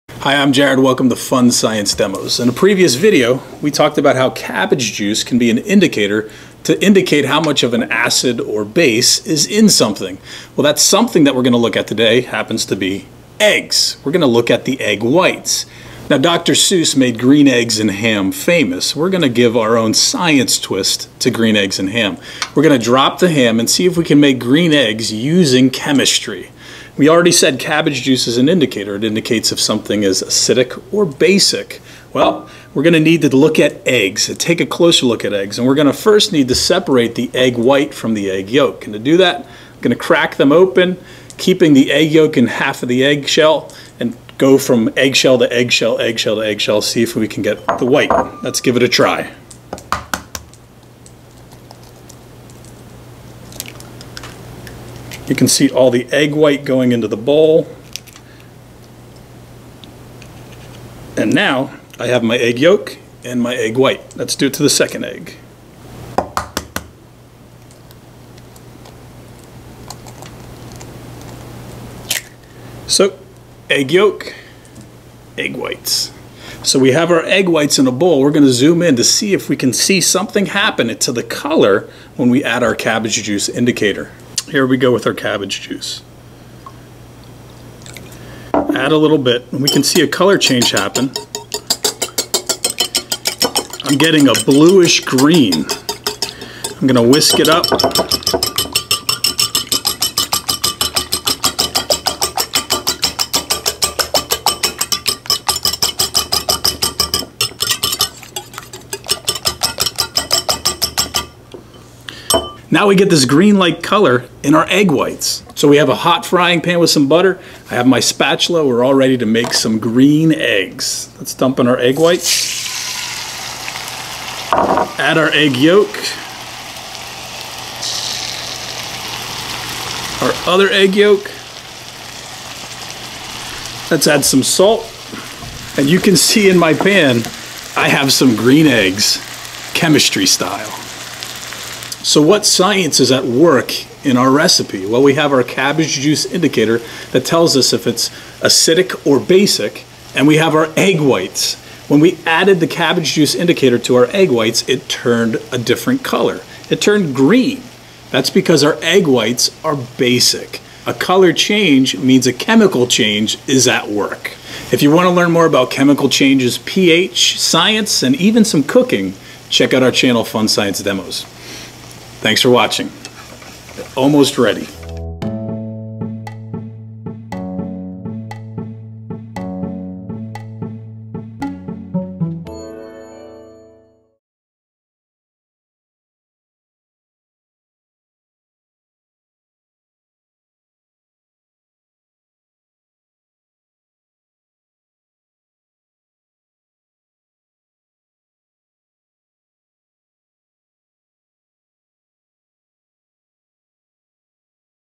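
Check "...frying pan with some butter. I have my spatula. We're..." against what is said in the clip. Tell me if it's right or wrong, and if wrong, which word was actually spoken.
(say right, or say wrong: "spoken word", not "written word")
right.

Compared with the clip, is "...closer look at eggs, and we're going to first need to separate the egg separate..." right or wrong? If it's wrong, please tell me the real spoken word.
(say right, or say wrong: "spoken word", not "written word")
wrong: "white", not "separate".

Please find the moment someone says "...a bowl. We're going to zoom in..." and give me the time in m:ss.
1:17.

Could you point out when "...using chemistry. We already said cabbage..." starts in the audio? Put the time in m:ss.
0:25.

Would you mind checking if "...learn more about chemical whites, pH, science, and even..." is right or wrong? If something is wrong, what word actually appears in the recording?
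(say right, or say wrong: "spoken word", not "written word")
wrong: "changes", not "whites".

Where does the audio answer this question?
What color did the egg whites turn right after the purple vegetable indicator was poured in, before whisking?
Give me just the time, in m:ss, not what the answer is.
1:34.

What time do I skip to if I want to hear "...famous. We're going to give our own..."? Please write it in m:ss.
0:18.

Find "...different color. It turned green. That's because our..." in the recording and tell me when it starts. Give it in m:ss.
2:35.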